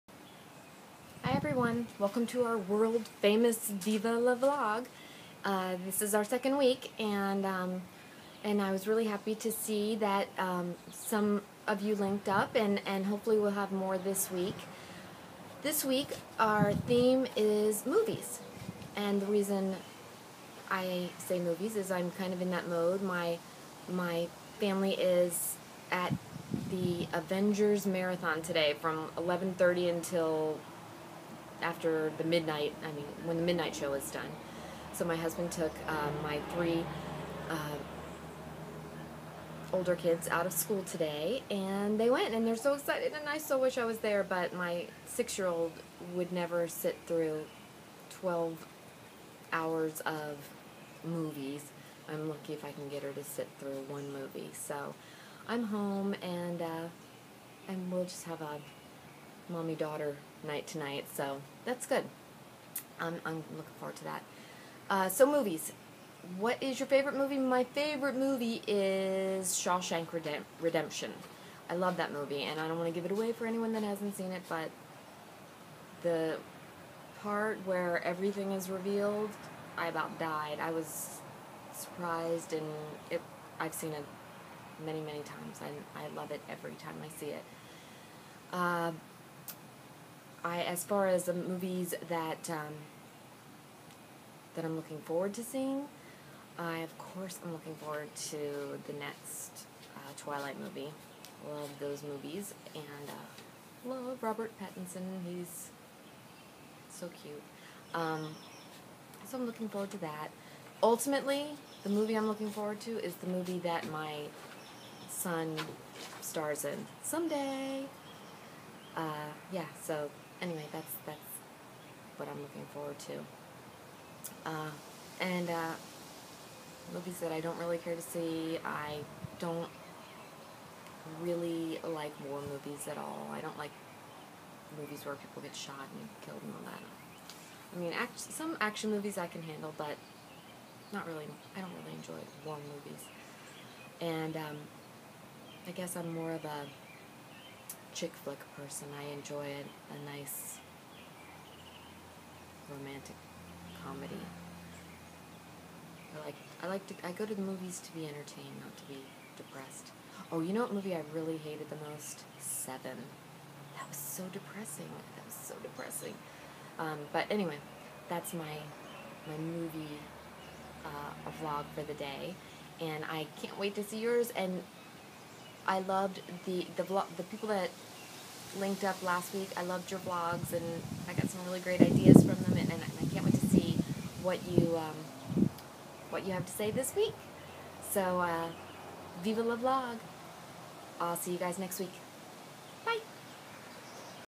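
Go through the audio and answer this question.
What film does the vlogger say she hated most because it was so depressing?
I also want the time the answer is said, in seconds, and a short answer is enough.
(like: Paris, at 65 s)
Seven, at 162 s.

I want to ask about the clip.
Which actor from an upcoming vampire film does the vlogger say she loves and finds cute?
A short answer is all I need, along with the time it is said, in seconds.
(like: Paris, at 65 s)
Robert Pattinson, at 104 s.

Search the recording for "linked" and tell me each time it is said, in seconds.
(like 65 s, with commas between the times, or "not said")
11 s, 178 s.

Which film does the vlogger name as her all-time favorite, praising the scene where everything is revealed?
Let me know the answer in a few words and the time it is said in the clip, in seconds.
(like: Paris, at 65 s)
Shawshank Redemption, at 69 s.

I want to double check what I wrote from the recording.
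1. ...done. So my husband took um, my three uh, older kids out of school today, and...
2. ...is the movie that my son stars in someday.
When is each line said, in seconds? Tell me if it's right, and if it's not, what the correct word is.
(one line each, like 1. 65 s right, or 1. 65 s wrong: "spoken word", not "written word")
1. 34 s right
2. 113 s right.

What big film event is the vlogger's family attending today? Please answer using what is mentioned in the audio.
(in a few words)
Avengers Marathon.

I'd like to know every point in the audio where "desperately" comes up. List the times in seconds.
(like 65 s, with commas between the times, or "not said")
not said.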